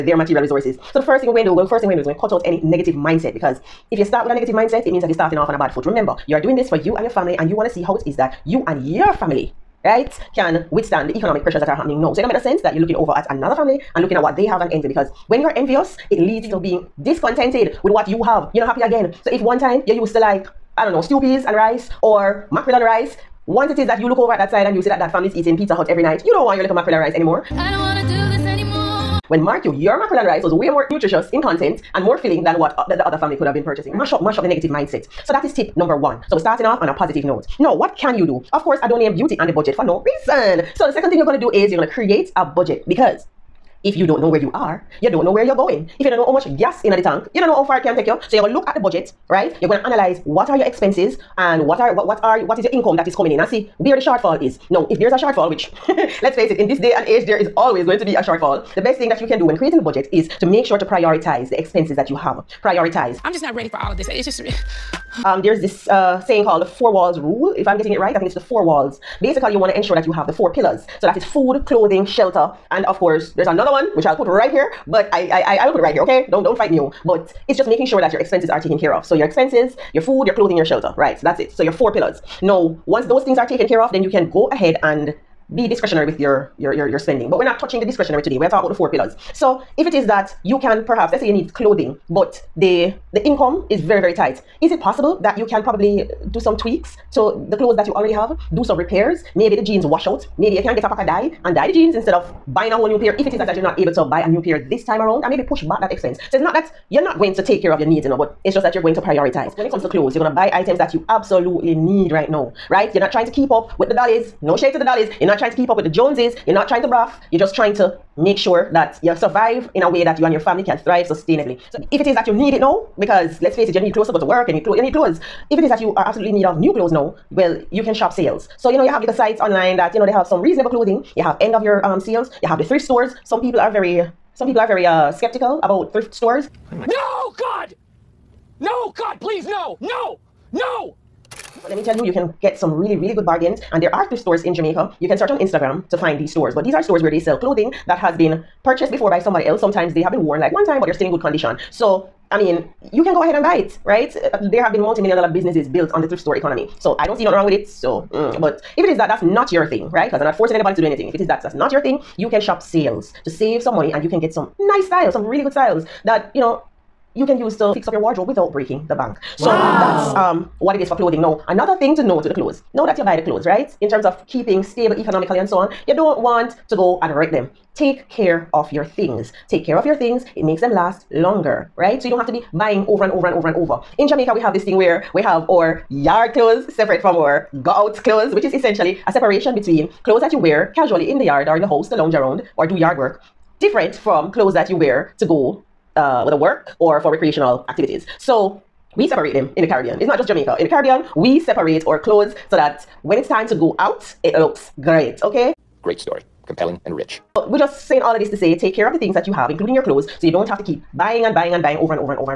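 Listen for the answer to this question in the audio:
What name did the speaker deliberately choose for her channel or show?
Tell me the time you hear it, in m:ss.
0:39.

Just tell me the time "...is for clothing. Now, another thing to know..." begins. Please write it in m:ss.
2:50.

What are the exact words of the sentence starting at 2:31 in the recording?
So, I mean, you can go ahead and buy it, right?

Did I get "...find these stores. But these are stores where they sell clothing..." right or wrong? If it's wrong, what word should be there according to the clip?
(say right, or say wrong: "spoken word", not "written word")
right.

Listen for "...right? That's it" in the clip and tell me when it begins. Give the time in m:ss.
1:20.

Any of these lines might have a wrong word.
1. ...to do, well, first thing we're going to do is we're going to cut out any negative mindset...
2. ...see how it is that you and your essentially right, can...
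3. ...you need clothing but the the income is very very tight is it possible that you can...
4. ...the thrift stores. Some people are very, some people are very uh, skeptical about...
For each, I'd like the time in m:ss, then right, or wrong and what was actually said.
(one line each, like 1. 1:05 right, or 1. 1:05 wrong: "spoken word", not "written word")
1. 0:01 right
2. 0:07 wrong: "family", not "essentially"
3. 1:31 right
4. 2:12 right.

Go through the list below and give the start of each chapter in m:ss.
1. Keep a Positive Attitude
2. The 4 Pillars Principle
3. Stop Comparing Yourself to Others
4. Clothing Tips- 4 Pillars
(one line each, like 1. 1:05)
1. 0:06
2. 1:13
3. 0:31
4. 1:48.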